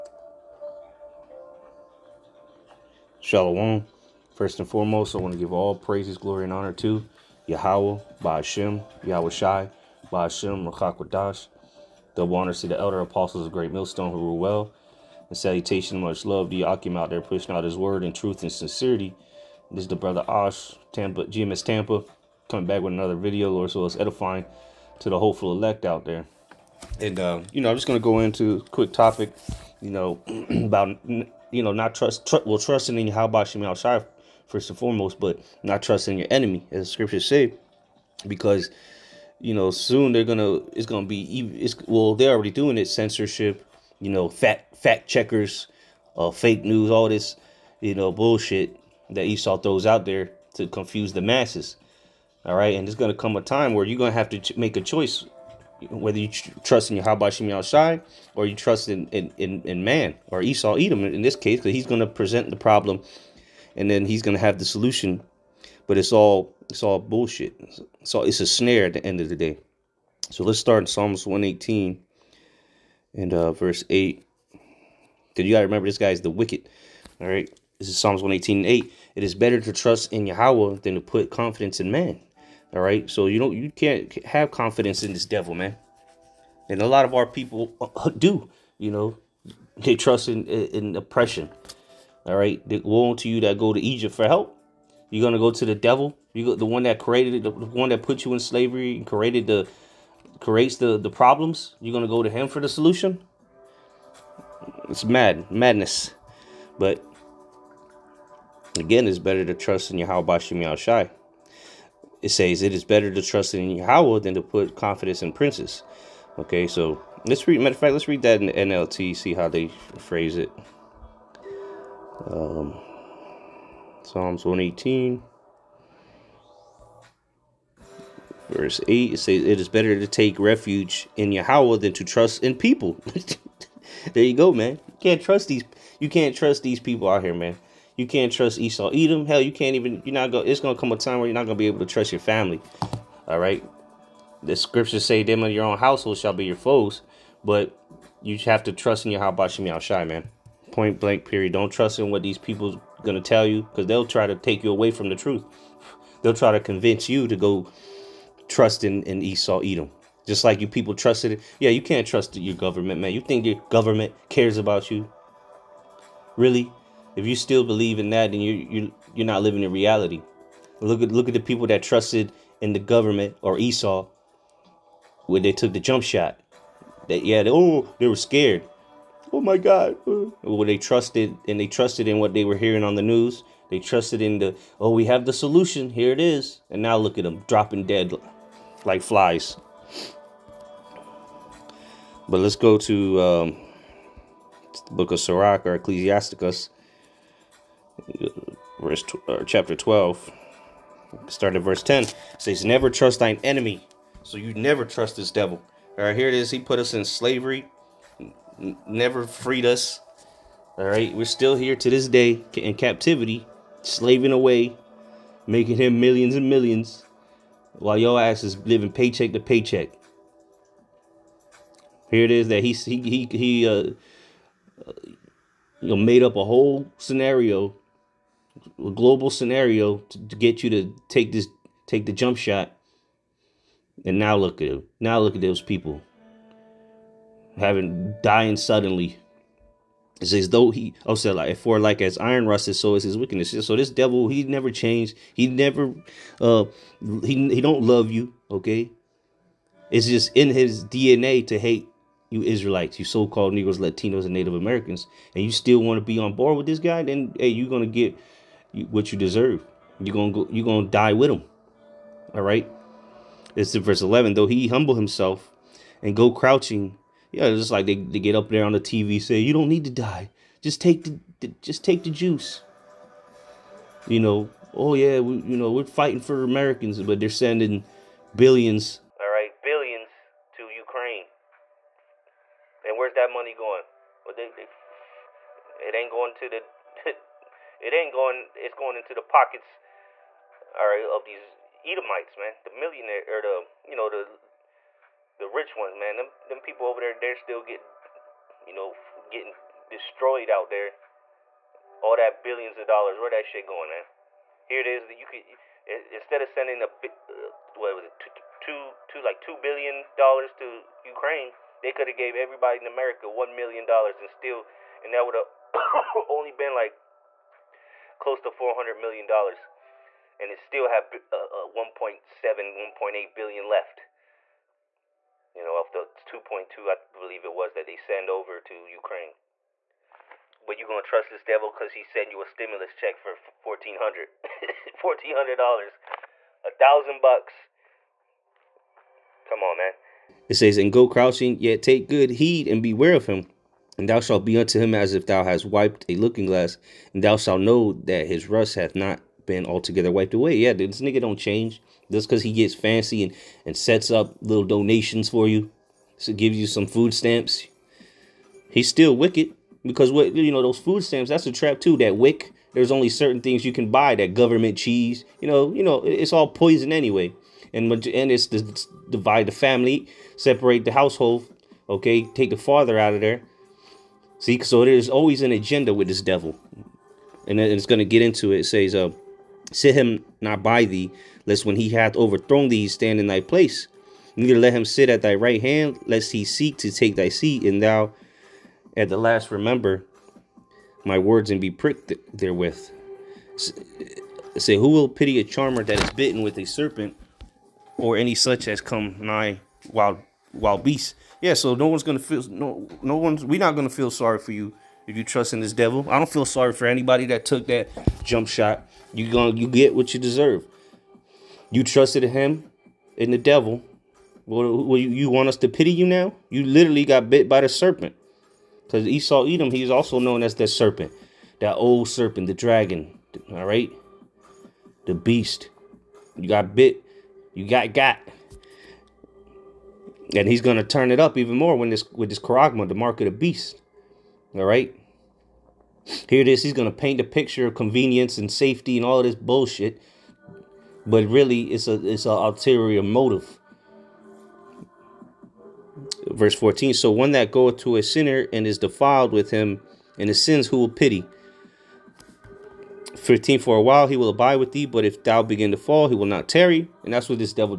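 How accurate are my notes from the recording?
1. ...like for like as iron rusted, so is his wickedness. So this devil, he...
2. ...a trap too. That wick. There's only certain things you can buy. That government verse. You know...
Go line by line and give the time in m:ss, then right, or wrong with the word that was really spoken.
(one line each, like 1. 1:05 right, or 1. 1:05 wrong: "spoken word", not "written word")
1. 4:01 right
2. 6:01 wrong: "cheese", not "verse".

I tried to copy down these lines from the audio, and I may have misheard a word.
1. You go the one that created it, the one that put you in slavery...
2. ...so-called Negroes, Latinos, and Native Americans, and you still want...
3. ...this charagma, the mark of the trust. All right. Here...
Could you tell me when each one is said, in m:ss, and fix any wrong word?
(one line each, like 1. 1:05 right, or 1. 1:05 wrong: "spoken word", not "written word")
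1. 1:36 right
2. 4:13 right
3. 7:12 wrong: "beast", not "trust".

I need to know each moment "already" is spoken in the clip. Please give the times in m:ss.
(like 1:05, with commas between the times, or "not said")
0:42.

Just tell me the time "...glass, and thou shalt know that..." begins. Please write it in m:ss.
5:46.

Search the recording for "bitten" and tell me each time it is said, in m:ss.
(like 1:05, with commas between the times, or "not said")
6:36.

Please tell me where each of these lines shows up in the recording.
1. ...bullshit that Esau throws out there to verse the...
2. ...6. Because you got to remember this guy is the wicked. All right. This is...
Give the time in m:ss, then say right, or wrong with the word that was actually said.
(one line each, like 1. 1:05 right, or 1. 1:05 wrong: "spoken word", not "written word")
1. 0:48 wrong: "confuse", not "verse"
2. 1:13 wrong: "8", not "6".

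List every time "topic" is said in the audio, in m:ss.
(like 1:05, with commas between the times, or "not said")
0:28.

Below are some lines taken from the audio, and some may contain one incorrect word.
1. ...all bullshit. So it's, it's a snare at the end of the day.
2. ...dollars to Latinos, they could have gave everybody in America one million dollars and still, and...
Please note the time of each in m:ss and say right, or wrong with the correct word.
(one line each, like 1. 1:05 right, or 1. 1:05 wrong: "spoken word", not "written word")
1. 1:06 right
2. 5:10 wrong: "Ukraine", not "Latinos".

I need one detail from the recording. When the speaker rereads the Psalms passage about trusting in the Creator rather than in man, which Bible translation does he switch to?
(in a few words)
NLT.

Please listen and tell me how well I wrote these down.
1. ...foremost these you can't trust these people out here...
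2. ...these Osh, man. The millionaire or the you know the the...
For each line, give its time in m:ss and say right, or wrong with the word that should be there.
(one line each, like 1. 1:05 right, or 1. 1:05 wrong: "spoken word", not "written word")
1. 2:15 wrong: "trust", not "foremost"
2. 4:51 wrong: "Edomites", not "Osh".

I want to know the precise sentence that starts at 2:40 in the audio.
Just like you people trusted it.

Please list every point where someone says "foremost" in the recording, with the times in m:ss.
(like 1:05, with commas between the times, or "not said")
0:04, 0:34.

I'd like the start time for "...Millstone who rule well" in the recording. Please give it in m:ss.
0:13.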